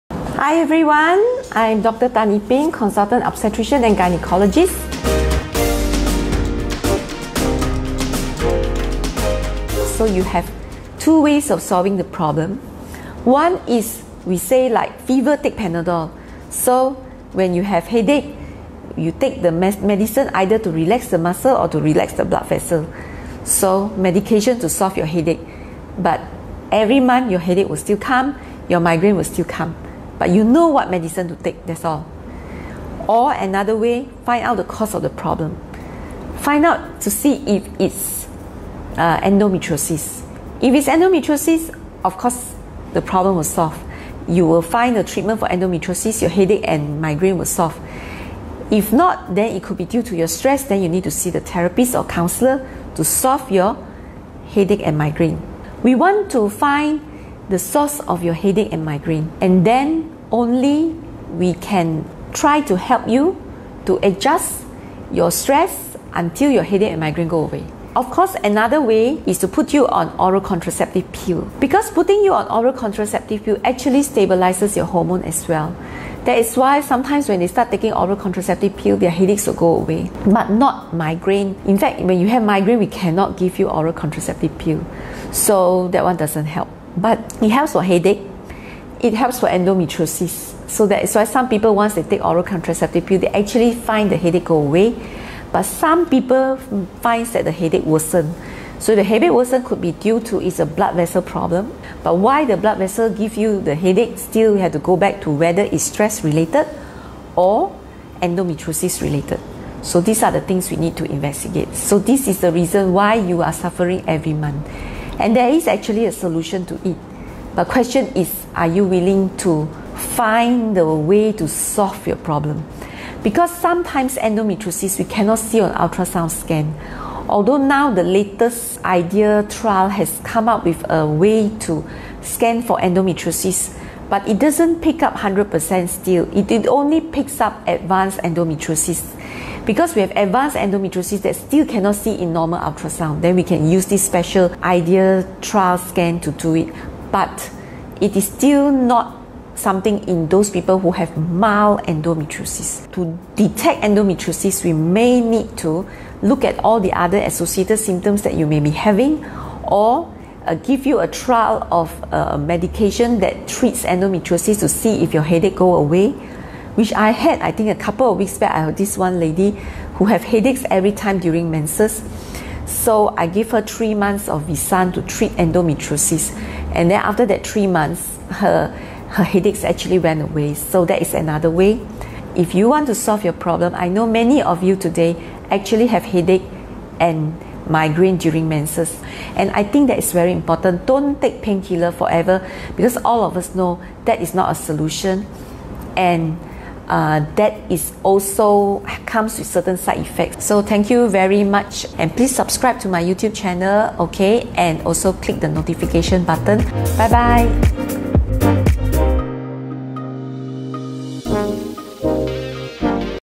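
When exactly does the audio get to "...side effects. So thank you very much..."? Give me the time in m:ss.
3:19.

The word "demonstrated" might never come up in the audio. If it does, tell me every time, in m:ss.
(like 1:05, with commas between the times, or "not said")
not said.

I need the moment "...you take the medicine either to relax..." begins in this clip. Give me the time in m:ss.
0:18.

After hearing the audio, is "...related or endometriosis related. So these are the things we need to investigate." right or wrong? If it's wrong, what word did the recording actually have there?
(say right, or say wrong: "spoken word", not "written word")
right.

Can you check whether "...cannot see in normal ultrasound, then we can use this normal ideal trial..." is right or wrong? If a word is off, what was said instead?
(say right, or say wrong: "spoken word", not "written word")
wrong: "special", not "normal".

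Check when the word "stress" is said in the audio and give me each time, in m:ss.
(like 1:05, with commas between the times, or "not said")
0:50, 1:05, 1:45.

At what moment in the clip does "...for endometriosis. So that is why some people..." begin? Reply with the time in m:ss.
1:29.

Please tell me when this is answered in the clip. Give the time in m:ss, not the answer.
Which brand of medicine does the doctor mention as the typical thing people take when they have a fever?
0:15.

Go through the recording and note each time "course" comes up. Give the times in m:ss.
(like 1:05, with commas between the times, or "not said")
0:42, 1:08.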